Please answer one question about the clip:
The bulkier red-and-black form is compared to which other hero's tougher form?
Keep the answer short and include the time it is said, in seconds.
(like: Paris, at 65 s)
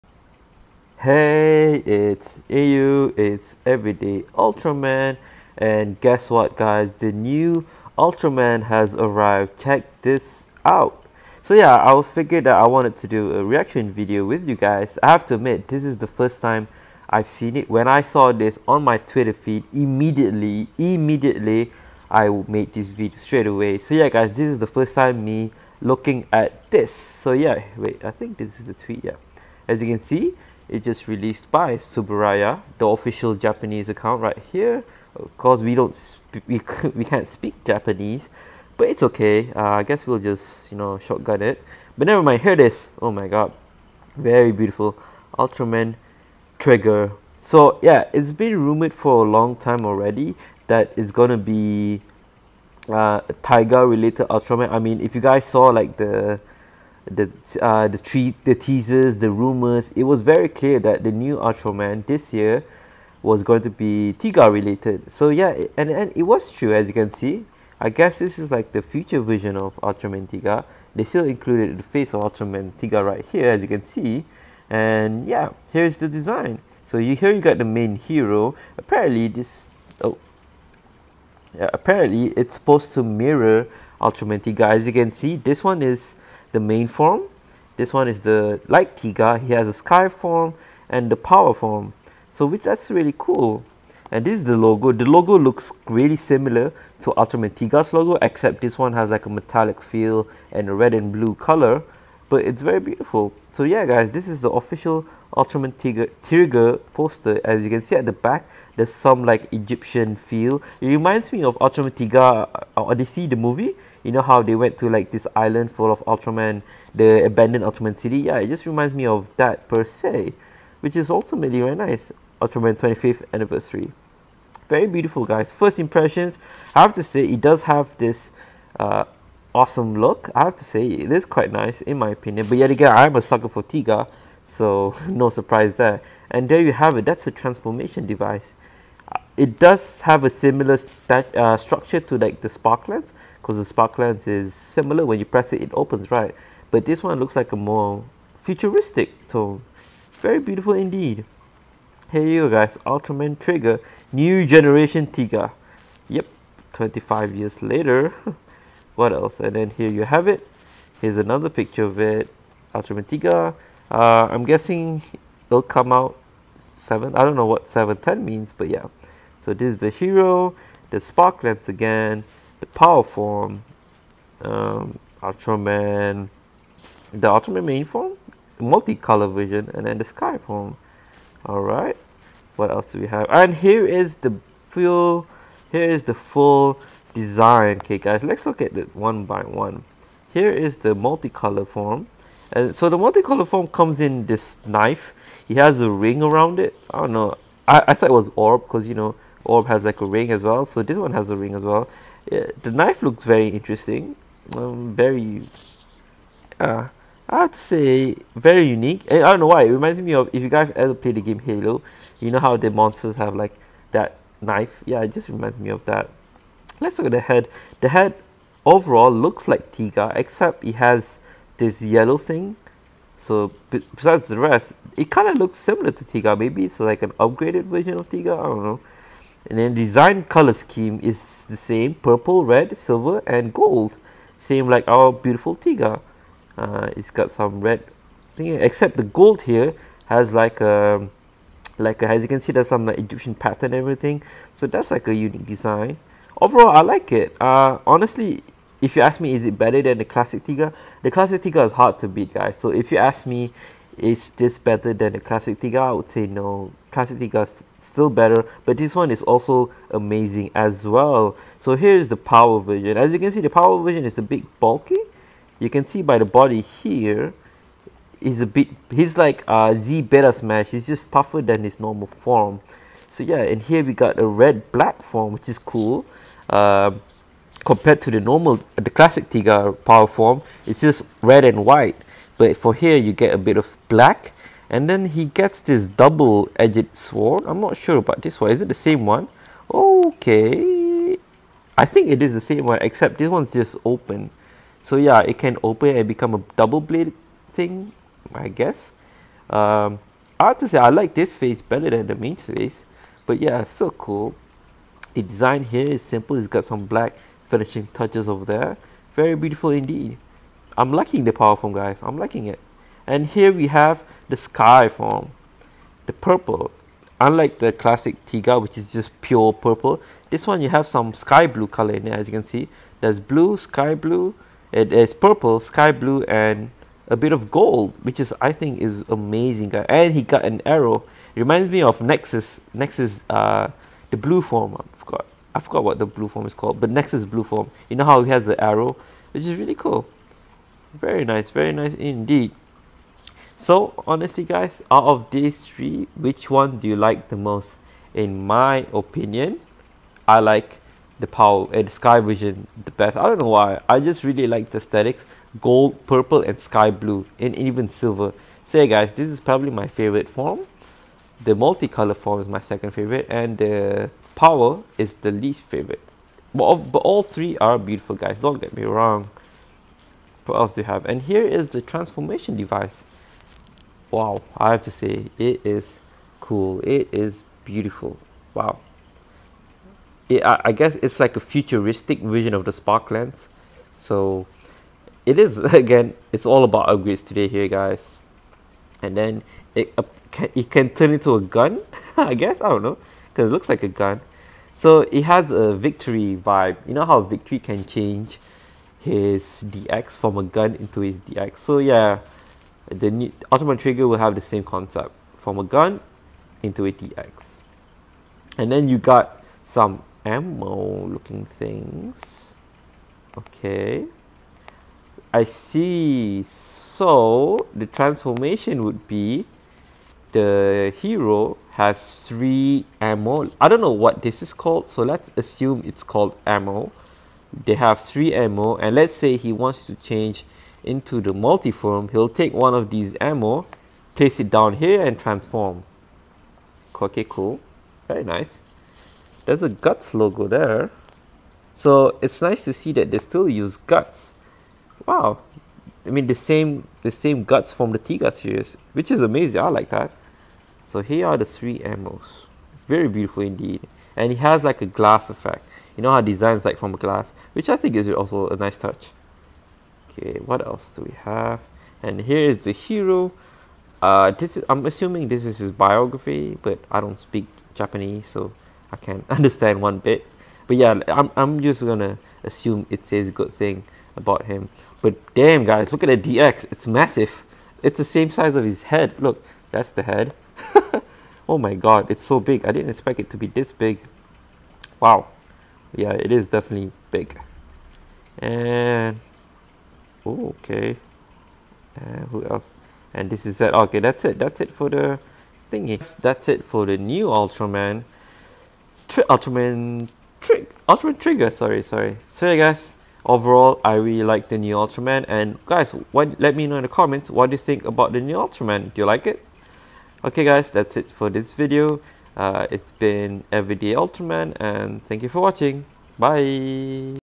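Z Beta Smash, at 269 s.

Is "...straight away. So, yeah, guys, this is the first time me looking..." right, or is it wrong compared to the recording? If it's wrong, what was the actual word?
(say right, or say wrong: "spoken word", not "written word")
right.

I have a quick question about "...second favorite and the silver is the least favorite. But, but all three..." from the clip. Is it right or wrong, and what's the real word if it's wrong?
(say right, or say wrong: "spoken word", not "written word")
wrong: "power", not "silver".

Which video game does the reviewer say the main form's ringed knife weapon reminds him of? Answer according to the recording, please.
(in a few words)
Halo.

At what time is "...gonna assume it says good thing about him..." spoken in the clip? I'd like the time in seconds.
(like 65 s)
471 s.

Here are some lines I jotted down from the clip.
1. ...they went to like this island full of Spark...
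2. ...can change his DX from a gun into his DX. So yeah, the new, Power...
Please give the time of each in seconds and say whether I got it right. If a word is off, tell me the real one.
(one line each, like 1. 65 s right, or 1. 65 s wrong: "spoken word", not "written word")
1. 114 s wrong: "Ultraman", not "Spark"
2. 397 s wrong: "Ultraman", not "Power".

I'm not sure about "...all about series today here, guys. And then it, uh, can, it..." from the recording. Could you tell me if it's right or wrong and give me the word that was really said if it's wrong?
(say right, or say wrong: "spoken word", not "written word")
wrong: "upgrades", not "series".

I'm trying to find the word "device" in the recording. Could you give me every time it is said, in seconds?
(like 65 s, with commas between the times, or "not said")
138 s, 372 s.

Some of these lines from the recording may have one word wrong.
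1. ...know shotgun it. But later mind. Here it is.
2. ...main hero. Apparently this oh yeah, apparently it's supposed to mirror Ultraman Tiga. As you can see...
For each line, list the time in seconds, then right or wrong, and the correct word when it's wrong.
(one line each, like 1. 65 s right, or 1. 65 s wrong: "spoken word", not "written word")
1. 40 s wrong: "never", not "later"
2. 77 s right.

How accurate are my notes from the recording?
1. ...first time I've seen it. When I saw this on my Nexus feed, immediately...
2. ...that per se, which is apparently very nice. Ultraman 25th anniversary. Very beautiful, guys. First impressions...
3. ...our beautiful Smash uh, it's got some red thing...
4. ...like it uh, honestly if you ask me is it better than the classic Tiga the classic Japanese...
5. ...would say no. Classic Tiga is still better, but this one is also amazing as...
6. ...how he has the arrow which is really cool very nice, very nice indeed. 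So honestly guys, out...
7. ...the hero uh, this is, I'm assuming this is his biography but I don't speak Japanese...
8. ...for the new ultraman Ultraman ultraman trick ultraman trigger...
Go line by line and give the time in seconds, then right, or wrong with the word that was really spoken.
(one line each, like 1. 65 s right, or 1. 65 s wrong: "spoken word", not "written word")
1. 16 s wrong: "Twitter", not "Nexus"
2. 119 s wrong: "ultimately", not "apparently"
3. 234 s wrong: "Tiga", not "Smash"
4. 246 s wrong: "Tiga", not "Japanese"
5. 255 s right
6. 338 s right
7. 462 s right
8. 496 s wrong: "Tri", not "Ultraman".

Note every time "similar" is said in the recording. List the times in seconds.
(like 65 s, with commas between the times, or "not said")
96 s, 140 s, 144 s, 225 s.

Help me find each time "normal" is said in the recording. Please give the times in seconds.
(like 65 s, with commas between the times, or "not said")
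271 s, 278 s.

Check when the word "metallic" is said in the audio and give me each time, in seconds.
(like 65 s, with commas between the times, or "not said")
99 s.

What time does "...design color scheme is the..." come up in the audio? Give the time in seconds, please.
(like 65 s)
229 s.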